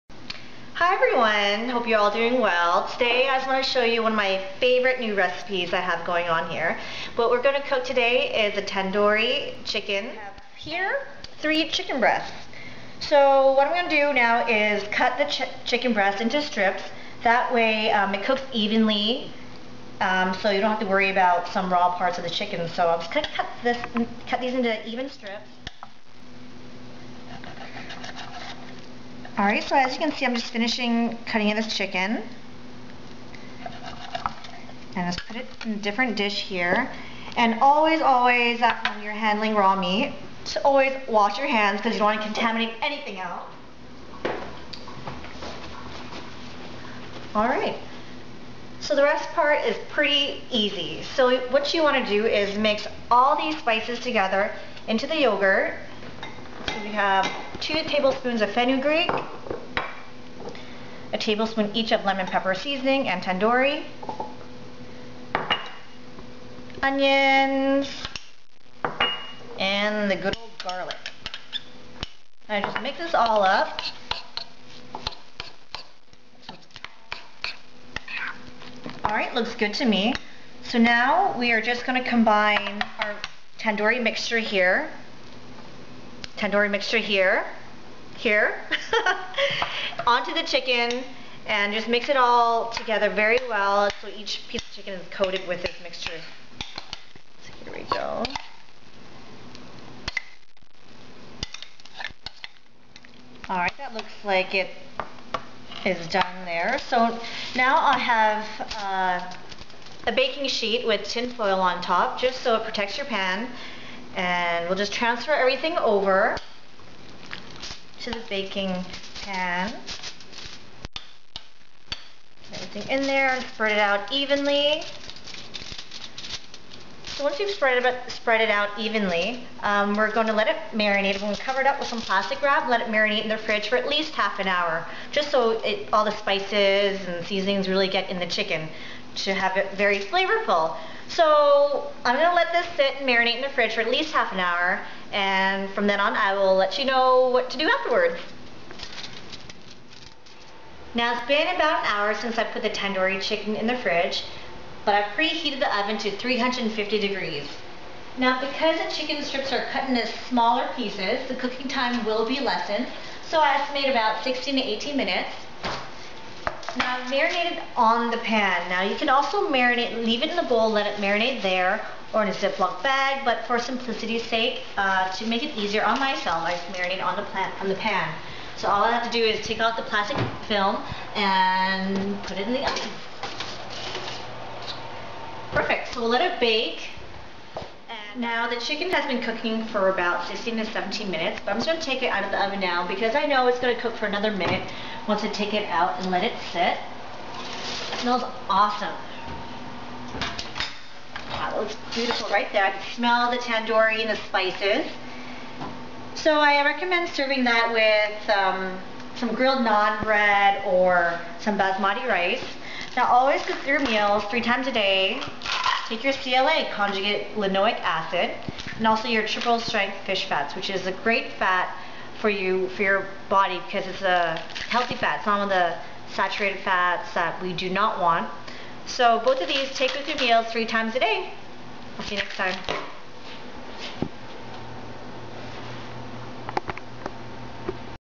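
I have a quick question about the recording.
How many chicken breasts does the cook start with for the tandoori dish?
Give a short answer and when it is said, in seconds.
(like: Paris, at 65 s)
3, at 11 s.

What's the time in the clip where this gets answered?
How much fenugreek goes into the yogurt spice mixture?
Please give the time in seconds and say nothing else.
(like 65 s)
57 s.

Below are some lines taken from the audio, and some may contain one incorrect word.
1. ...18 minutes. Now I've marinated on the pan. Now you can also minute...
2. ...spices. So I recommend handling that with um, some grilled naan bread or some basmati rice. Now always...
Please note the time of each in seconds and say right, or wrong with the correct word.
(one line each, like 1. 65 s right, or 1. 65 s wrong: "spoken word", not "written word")
1. 164 s wrong: "marinate", not "minute"
2. 204 s wrong: "serving", not "handling".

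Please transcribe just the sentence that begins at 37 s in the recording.
And always, always, uh, when you're handling raw meat, to always wash your hands because you don't want to contaminate anything else.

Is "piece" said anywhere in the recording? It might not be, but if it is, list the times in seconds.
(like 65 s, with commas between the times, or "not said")
94 s, 160 s.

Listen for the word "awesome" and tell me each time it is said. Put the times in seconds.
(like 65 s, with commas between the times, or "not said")
198 s.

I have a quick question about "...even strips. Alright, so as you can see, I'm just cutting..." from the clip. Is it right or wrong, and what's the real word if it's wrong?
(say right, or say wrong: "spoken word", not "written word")
wrong: "finishing", not "cutting".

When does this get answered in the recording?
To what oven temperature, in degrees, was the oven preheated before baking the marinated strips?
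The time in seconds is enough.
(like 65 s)
156 s.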